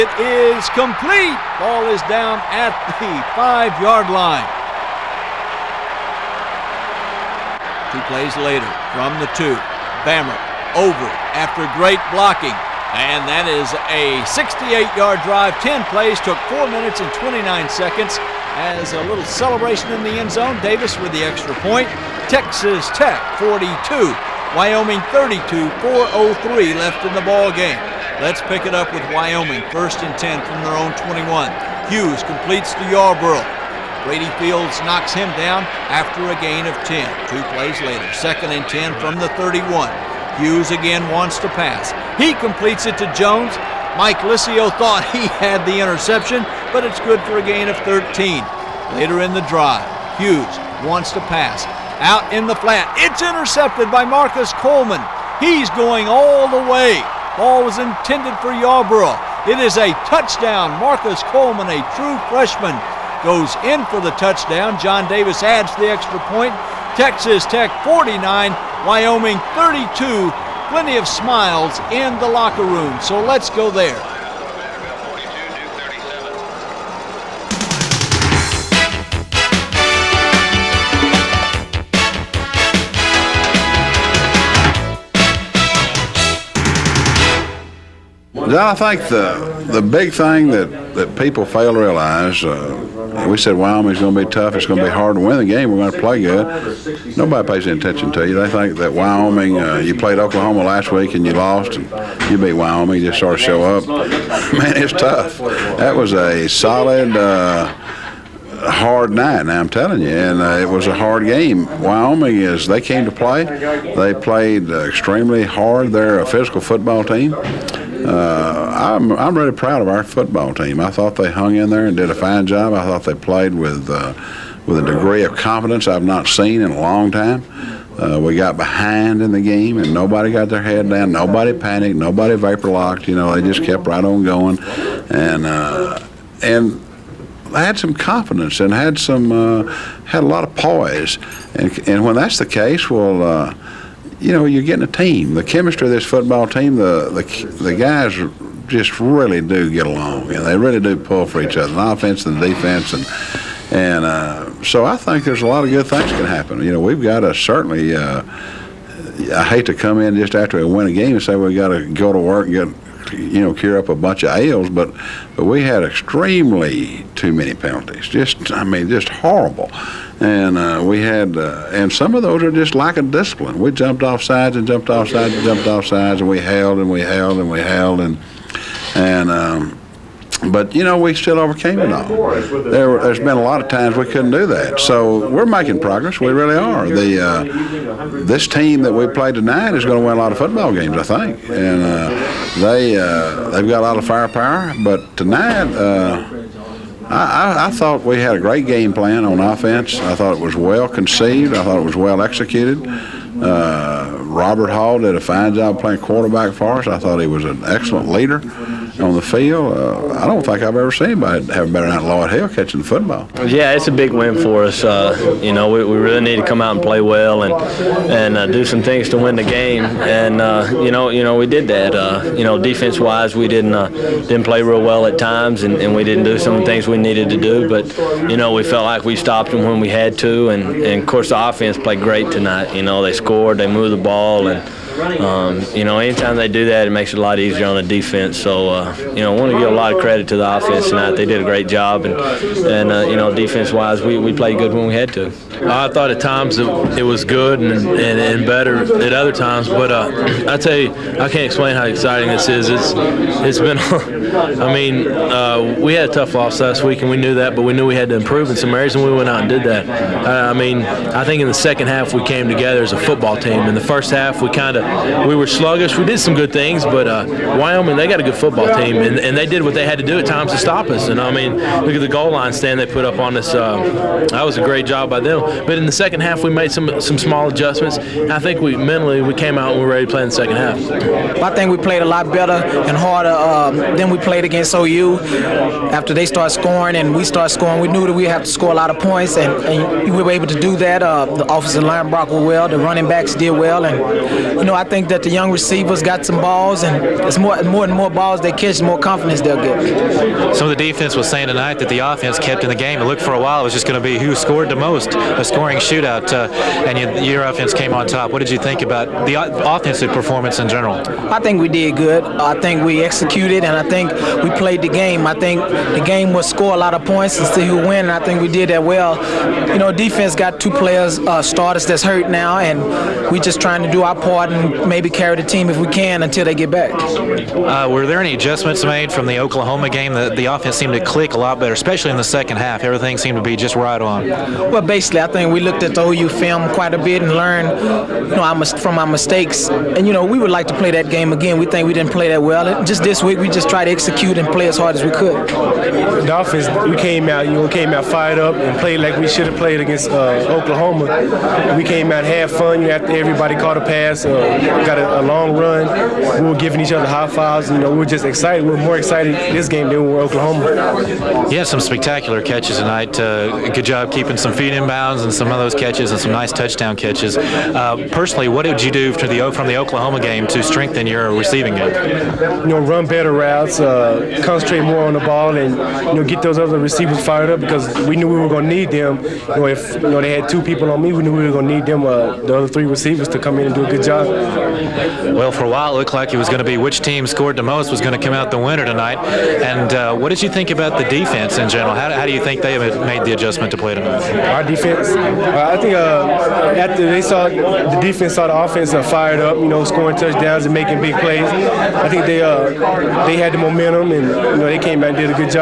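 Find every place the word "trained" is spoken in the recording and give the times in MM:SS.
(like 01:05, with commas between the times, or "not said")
not said.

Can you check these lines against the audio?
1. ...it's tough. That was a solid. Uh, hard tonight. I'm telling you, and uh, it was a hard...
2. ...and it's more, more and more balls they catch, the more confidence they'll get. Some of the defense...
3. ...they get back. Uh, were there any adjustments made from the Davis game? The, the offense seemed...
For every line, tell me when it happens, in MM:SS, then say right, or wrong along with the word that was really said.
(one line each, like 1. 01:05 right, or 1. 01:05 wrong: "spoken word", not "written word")
1. 01:44 wrong: "night", not "tonight"
2. 04:56 right
3. 05:26 wrong: "Oklahoma", not "Davis".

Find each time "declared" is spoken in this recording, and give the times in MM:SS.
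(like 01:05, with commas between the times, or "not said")
not said.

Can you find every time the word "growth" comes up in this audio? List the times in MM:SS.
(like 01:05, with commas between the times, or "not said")
not said.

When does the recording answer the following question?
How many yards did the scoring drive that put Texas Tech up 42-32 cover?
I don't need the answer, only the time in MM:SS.
00:14.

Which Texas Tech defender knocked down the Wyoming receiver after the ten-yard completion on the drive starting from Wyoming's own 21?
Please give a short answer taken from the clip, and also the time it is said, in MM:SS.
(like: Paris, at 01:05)
Brady Fields, at 00:34.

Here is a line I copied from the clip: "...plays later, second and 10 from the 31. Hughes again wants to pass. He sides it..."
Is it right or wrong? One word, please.
wrong.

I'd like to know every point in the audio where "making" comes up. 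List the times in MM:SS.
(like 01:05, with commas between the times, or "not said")
03:05, 06:40.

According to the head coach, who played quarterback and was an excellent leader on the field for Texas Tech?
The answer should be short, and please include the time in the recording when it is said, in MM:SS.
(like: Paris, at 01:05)
Robert Hall, at 03:24.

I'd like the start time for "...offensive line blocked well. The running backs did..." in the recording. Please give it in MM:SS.
04:51.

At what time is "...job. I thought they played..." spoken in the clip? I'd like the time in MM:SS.
02:02.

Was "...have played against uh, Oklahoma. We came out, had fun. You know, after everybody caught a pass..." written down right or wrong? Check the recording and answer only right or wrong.
right.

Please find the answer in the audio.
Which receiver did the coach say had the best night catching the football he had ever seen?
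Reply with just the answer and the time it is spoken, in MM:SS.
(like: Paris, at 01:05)
Lloyd Hill, at 03:32.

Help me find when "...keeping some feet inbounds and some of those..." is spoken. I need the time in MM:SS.
06:04.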